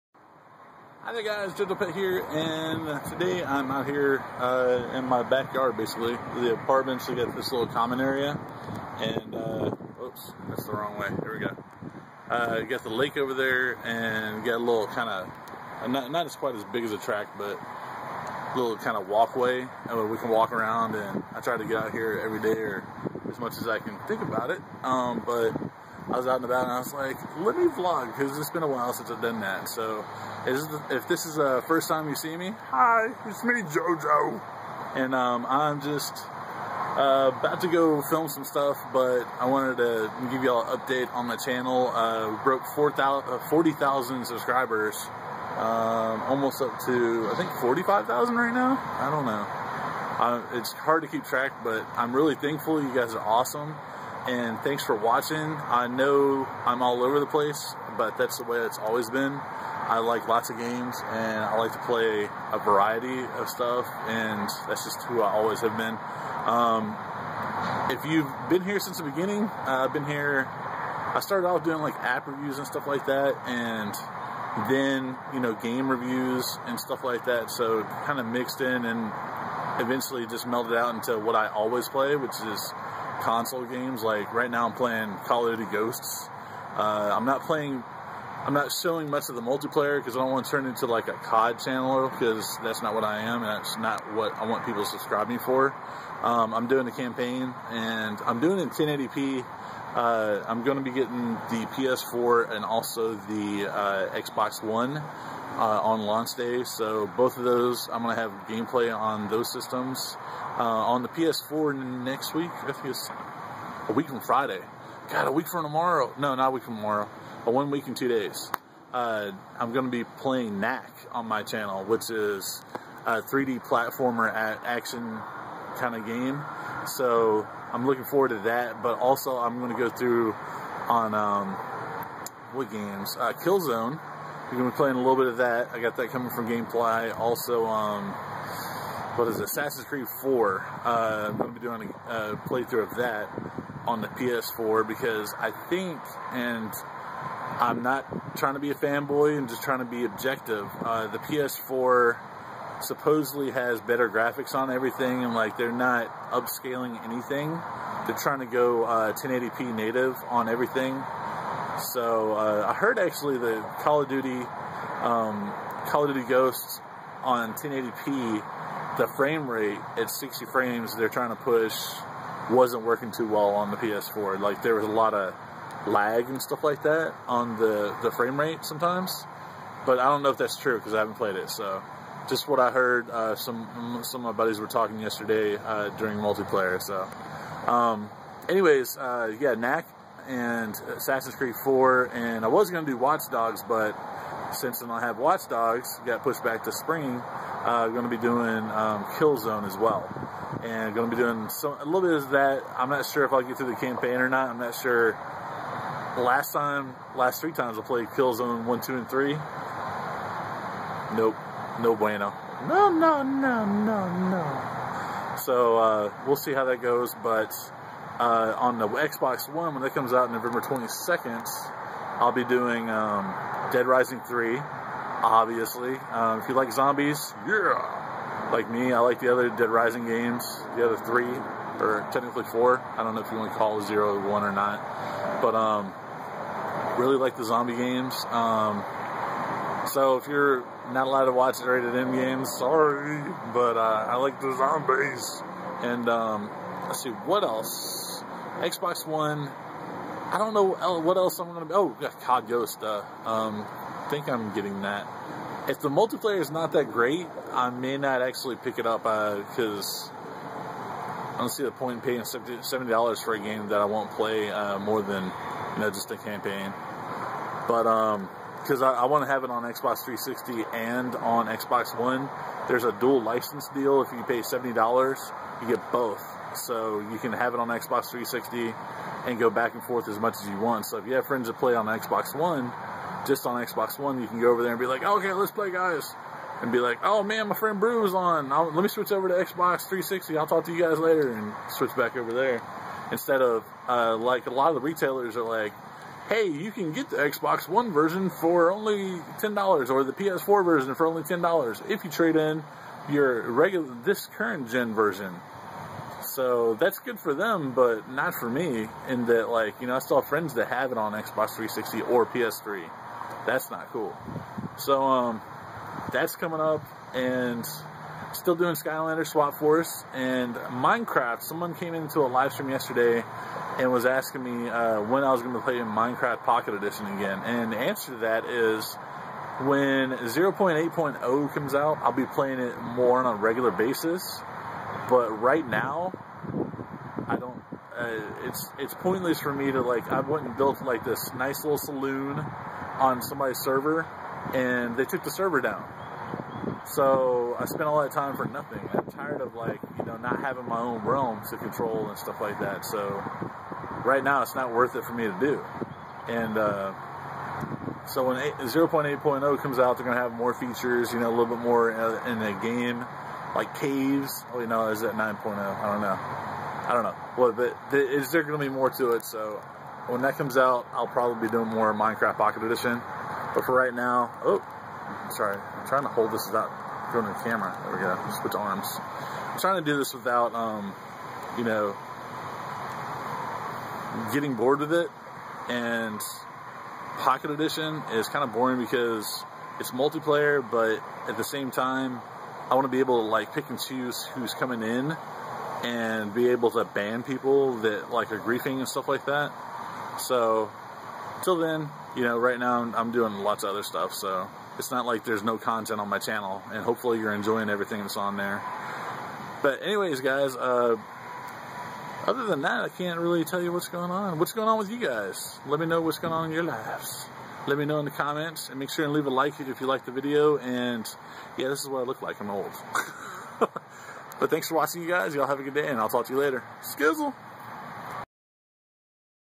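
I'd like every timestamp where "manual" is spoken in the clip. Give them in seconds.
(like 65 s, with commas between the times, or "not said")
not said.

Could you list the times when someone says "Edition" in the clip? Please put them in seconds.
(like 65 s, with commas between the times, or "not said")
326 s, 372 s, 387 s.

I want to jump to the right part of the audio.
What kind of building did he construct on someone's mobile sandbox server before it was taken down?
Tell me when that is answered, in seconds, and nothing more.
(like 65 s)
341 s.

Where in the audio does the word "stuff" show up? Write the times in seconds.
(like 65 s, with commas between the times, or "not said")
38 s, 63 s, 72 s, 76 s, 176 s, 352 s, 398 s, 403 s.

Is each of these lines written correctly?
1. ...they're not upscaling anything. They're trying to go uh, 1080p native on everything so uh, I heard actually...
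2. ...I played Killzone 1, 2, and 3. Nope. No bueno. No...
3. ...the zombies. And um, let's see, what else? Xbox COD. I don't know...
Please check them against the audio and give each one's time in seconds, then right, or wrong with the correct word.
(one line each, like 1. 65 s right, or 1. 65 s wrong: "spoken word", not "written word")
1. 155 s right
2. 207 s right
3. 244 s wrong: "One", not "COD".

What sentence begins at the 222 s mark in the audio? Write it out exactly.
I'll be doing um, Dead Rising 3, obviously.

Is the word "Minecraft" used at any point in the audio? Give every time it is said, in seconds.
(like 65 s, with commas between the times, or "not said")
320 s, 325 s, 371 s.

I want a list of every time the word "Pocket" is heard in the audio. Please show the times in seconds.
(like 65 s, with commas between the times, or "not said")
326 s, 372 s, 387 s.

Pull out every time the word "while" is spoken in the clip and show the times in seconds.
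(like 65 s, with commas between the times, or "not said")
28 s.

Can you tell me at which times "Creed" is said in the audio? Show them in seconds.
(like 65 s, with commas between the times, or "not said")
139 s, 191 s.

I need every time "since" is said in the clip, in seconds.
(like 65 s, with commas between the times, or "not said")
28 s, 68 s, 194 s.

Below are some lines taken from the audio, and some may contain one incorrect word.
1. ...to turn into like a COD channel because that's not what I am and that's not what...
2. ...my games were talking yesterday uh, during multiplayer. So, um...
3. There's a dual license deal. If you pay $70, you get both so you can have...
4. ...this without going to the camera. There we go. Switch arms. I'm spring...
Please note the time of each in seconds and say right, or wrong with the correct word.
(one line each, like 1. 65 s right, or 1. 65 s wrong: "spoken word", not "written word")
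1. 90 s right
2. 184 s wrong: "buddies", not "games"
3. 272 s right
4. 376 s wrong: "trying", not "spring".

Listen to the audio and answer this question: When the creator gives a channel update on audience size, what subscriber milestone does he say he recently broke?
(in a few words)
40,000.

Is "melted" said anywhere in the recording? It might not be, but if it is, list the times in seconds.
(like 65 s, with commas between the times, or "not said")
80 s.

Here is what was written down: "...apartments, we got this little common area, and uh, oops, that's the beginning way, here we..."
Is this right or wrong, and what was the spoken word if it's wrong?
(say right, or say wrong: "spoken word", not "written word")
wrong: "wrong", not "beginning".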